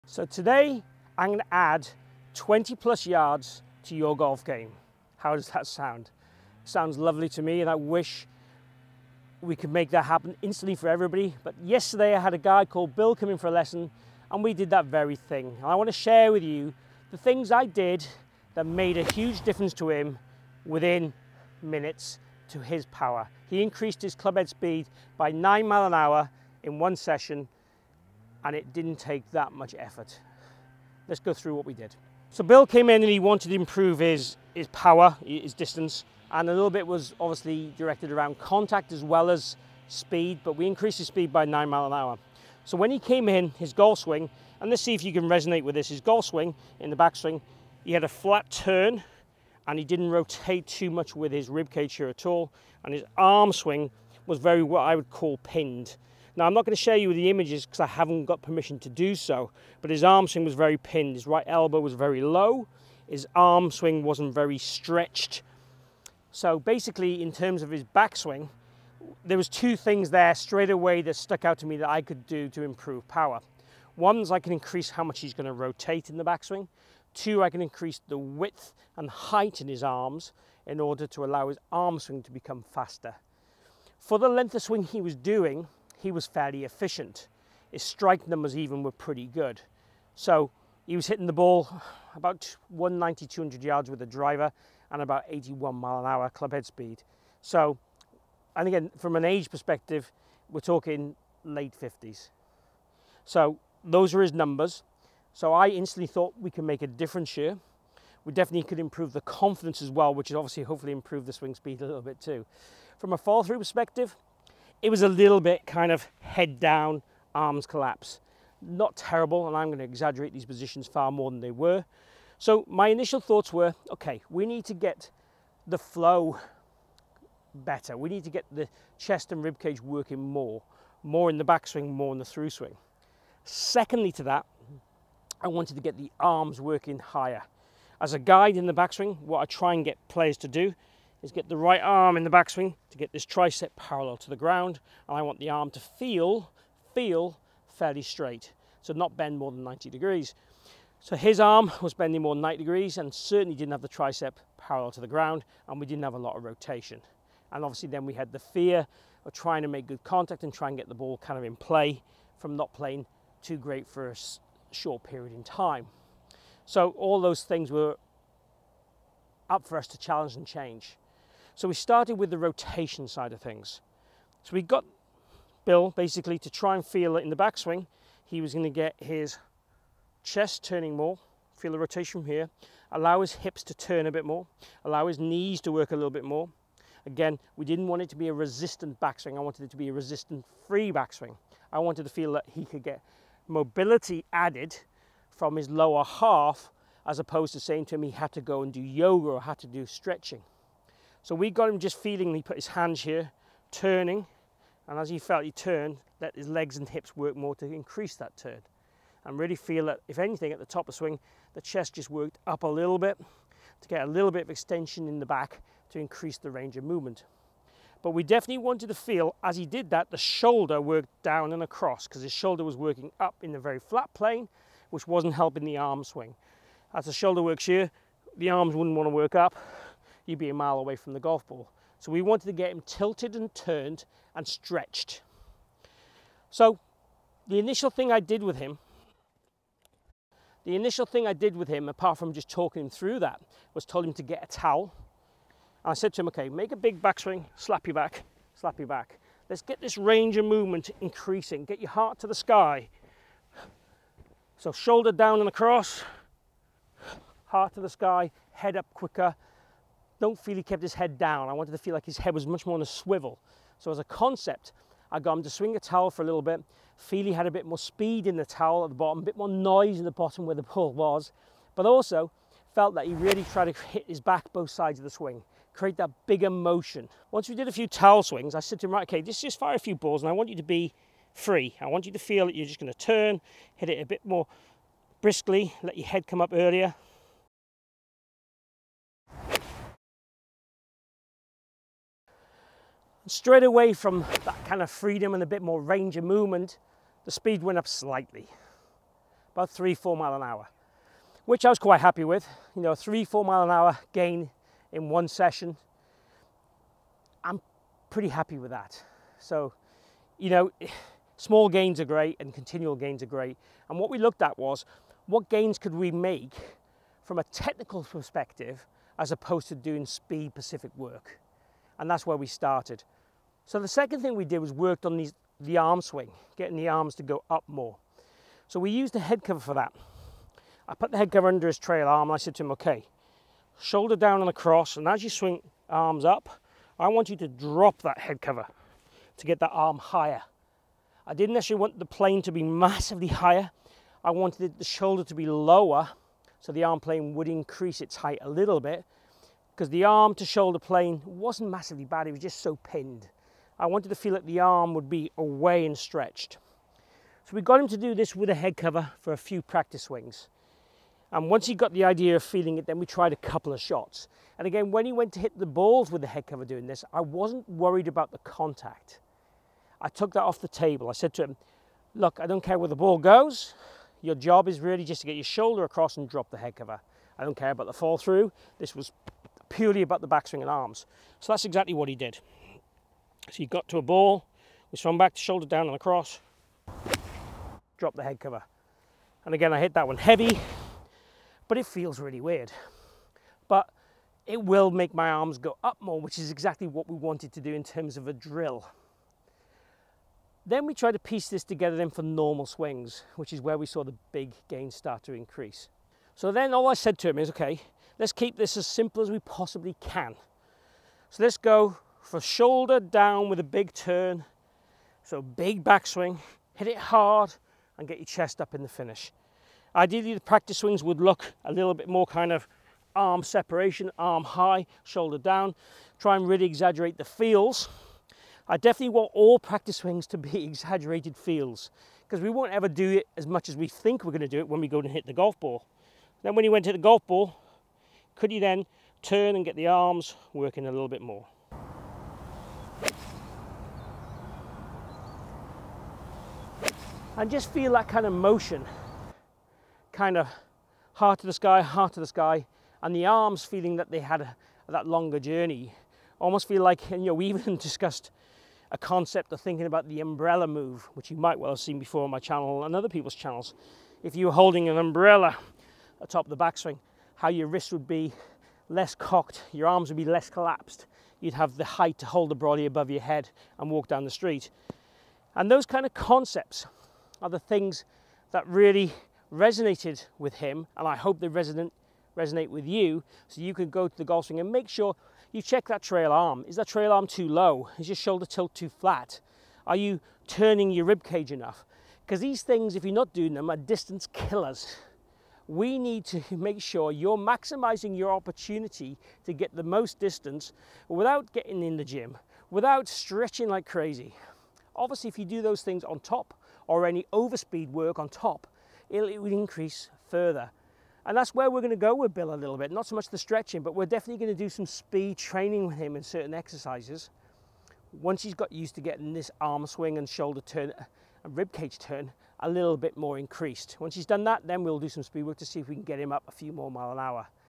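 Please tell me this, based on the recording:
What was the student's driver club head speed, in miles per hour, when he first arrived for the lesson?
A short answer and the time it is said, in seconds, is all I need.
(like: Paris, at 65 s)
81, at 95 s.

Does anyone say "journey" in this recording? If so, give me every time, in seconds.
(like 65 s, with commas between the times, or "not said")
455 s.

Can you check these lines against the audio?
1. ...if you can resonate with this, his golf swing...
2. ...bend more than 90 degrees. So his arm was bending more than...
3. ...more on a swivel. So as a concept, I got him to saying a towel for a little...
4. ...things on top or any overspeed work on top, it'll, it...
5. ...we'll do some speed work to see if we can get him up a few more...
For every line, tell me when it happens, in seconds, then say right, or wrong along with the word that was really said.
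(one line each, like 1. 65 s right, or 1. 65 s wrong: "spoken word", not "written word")
1. 44 s right
2. 149 s right
3. 262 s wrong: "swing", not "saying"
4. 505 s right
5. 524 s right.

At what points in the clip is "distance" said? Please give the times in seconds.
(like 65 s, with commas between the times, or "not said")
35 s, 493 s, 500 s.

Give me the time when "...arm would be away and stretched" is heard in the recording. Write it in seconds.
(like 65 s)
354 s.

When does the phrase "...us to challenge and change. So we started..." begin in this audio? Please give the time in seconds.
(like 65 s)
169 s.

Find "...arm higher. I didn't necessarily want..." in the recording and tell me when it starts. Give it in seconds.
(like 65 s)
339 s.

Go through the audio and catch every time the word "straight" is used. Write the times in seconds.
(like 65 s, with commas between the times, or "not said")
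70 s, 148 s, 293 s.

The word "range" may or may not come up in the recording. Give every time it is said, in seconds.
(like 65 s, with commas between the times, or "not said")
216 s, 249 s, 295 s.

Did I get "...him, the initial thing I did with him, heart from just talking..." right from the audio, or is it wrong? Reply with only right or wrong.
wrong.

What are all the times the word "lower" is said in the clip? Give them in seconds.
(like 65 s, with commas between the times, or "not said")
195 s, 345 s.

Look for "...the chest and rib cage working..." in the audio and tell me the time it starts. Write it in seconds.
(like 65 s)
128 s.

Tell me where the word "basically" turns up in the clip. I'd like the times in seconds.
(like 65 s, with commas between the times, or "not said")
66 s, 175 s.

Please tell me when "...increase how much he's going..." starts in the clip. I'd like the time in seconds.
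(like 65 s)
74 s.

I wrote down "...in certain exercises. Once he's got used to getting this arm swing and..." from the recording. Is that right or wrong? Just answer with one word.
right.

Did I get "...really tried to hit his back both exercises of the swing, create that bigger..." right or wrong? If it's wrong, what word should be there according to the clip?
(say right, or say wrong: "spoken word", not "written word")
wrong: "sides", not "exercises".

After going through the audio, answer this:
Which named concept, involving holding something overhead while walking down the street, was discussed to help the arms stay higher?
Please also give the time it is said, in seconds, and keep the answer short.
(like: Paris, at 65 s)
The umbrella move, at 460 s.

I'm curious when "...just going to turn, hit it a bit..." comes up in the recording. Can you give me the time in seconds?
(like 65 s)
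282 s.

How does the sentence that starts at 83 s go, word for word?
For the length of swing he was doing, he was fairly efficient.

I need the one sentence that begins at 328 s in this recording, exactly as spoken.
So we used a head cover for that.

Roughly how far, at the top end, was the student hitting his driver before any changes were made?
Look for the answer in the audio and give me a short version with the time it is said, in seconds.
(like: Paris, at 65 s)
200 yards, at 93 s.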